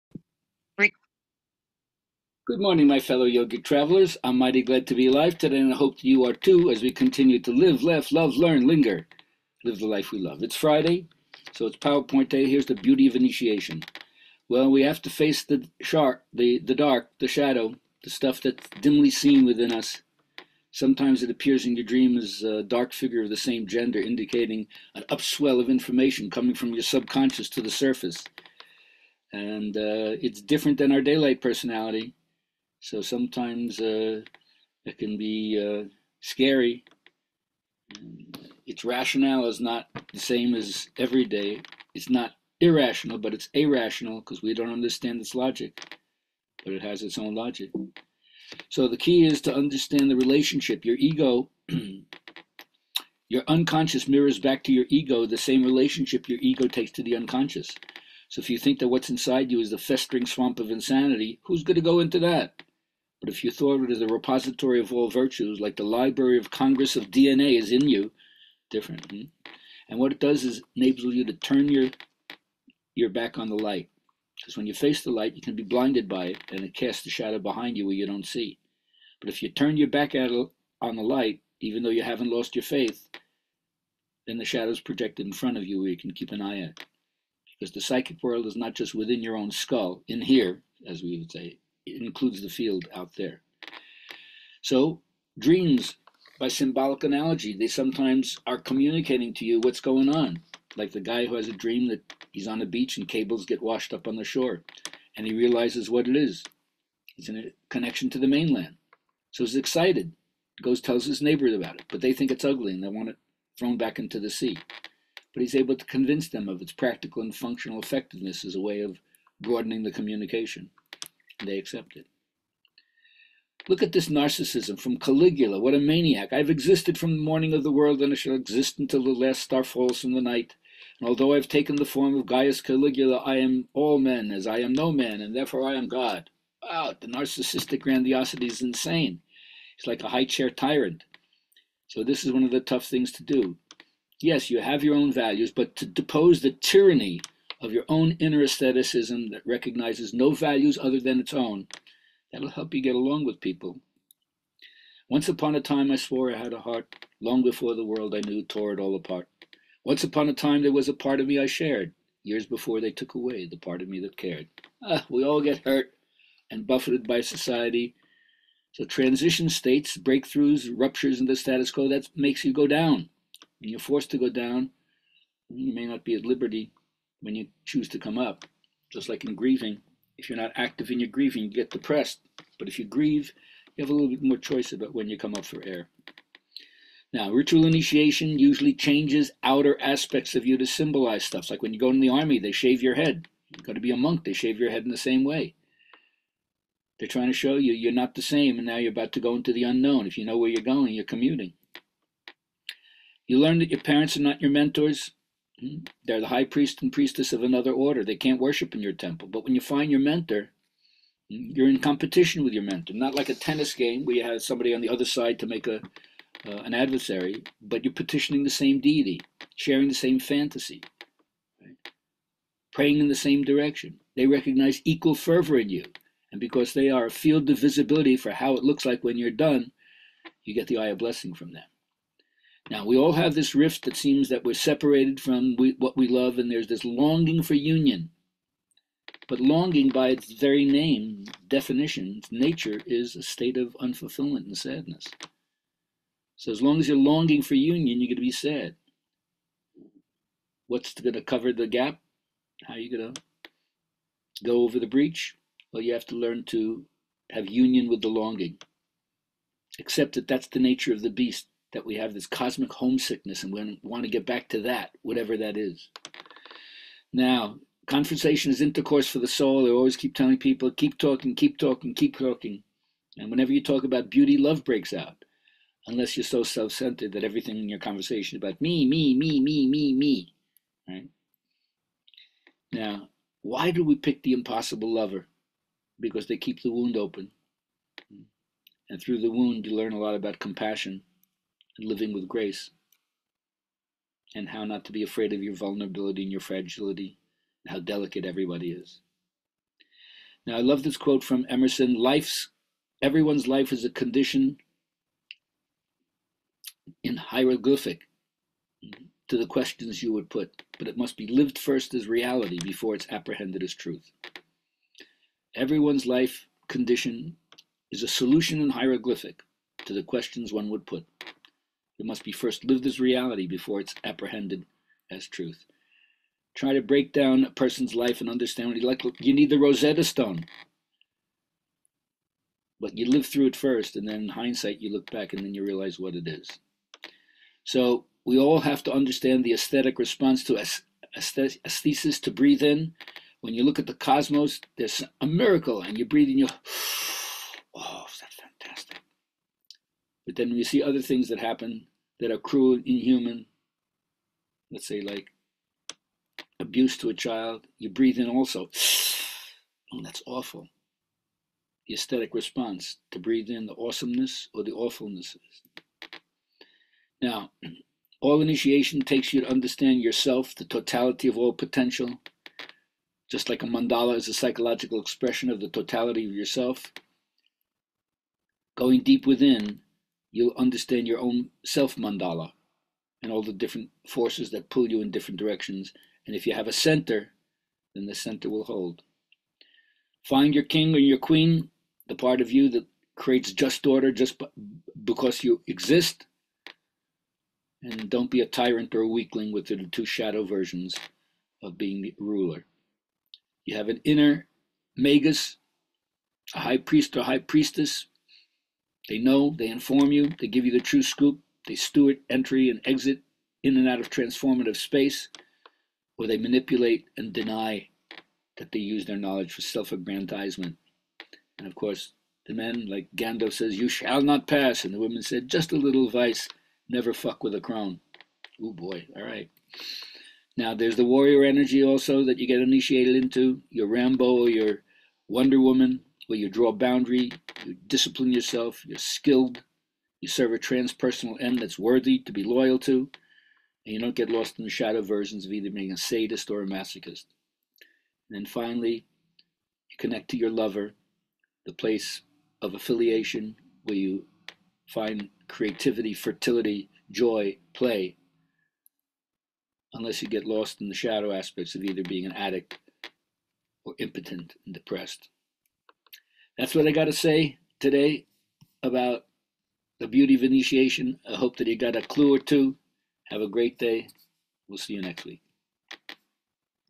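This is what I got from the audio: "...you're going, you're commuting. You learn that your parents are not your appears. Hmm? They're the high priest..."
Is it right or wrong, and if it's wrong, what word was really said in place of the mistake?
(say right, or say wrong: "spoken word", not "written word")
wrong: "mentors", not "appears".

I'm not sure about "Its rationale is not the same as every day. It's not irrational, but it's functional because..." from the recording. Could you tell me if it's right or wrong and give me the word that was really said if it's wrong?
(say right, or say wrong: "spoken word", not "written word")
wrong: "irrational", not "functional".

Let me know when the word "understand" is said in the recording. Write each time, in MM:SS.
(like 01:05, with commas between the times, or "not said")
00:44, 00:49, 05:28, 05:38, 06:09, 06:20.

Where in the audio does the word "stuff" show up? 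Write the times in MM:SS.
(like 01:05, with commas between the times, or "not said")
00:18, 03:11.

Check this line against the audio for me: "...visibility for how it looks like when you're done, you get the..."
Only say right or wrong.
right.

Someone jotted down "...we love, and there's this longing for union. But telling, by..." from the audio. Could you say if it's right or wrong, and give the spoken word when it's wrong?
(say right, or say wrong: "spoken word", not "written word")
wrong: "longing", not "telling".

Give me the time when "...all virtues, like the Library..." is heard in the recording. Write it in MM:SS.
01:04.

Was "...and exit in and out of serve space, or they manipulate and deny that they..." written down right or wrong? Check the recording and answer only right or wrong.
wrong.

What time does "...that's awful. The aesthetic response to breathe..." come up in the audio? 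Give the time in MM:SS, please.
06:00.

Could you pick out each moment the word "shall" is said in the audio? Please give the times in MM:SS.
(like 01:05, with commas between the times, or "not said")
02:08, 07:03.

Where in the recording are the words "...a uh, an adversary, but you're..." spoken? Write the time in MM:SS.
03:35.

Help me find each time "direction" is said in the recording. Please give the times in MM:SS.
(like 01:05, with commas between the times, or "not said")
03:43, 06:25.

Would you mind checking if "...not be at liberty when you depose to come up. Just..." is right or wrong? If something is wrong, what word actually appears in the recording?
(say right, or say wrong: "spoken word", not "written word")
wrong: "choose", not "depose".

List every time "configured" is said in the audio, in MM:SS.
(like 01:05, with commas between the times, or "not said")
not said.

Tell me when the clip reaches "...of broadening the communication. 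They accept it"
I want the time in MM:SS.
01:58.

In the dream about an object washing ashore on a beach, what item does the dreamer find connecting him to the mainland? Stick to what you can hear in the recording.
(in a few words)
cables.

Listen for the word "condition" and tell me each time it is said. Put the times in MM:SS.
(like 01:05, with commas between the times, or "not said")
05:03, 05:16.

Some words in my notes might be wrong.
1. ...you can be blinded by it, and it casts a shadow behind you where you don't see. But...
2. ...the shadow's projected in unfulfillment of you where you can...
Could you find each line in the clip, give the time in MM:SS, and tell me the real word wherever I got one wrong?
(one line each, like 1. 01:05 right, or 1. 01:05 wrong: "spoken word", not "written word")
1. 01:15 right
2. 01:24 wrong: "front", not "unfulfillment".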